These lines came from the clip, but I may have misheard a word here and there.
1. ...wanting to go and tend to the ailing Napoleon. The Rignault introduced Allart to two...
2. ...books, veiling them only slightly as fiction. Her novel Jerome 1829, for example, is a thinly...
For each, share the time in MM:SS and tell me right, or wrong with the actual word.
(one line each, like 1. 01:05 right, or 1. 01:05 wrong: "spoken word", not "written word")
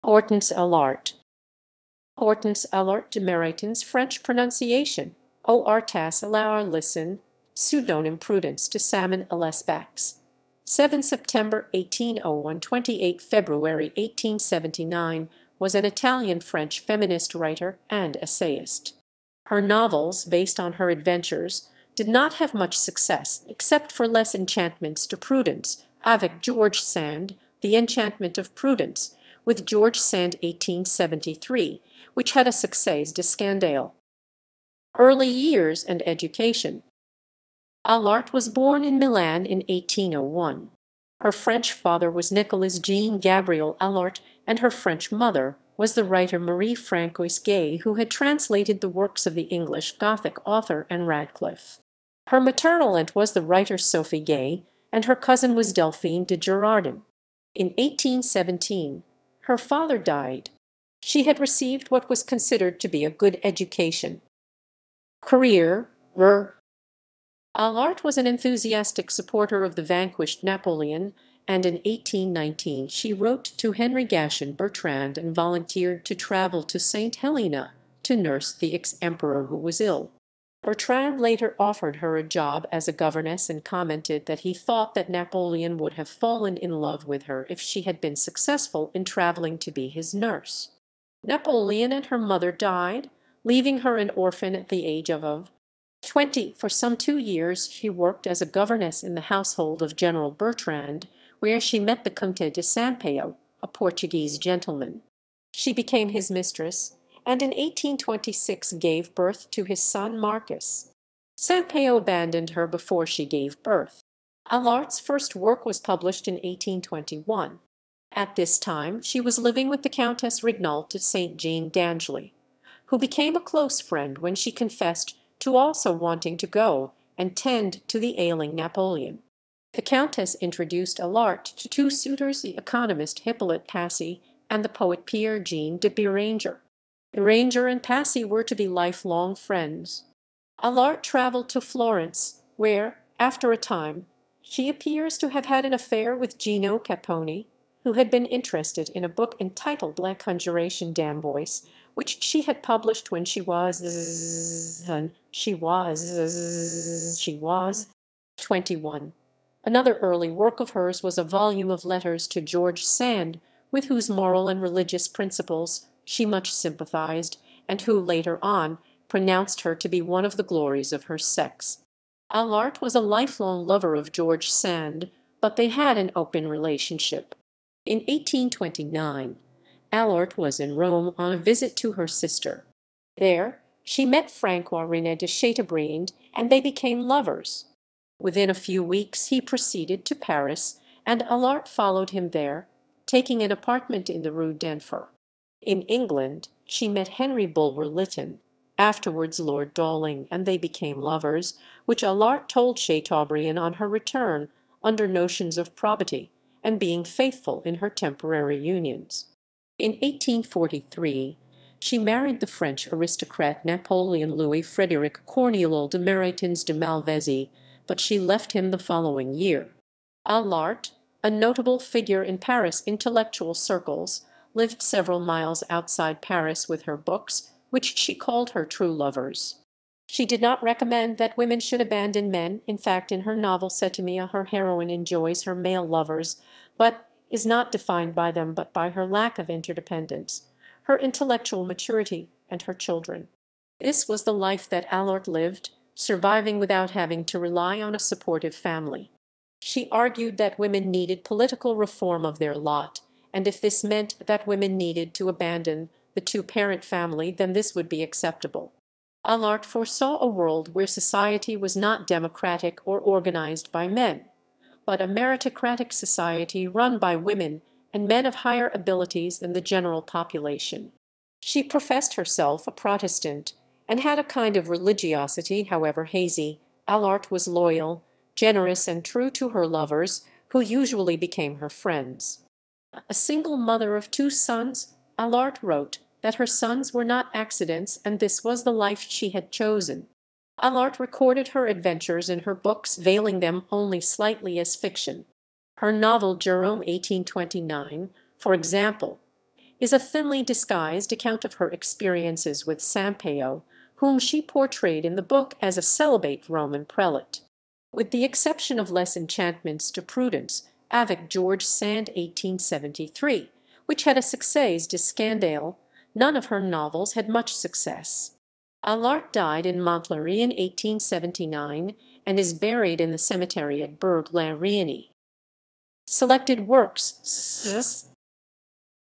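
1. 02:05 wrong: "Countess", not "Rignault"
2. 04:52 right.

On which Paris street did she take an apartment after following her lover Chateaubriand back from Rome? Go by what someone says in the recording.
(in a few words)
Rue d'Enfer.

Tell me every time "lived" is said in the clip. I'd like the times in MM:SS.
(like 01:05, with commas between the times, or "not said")
03:44, 04:05.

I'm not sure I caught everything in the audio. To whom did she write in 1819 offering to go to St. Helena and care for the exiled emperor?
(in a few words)
Henry Gatien Bertrand.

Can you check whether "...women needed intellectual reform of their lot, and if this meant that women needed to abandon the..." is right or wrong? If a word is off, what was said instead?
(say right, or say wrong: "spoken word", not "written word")
wrong: "political", not "intellectual".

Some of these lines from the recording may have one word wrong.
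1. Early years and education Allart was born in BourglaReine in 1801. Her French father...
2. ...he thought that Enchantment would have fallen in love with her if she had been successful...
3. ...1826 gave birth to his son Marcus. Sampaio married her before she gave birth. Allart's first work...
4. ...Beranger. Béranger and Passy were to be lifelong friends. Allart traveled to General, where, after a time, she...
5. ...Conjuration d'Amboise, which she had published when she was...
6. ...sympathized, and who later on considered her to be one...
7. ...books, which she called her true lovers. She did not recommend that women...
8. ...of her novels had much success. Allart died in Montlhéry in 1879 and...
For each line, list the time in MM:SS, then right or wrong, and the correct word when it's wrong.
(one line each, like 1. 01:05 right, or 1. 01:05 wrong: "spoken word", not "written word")
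1. 00:34 wrong: "Milan", not "BourglaReine"
2. 01:24 wrong: "Napoleon", not "Enchantment"
3. 01:47 wrong: "abandoned", not "married"
4. 02:15 wrong: "Florence", not "General"
5. 02:30 right
6. 02:46 wrong: "pronounced", not "considered"
7. 03:46 right
8. 05:16 right.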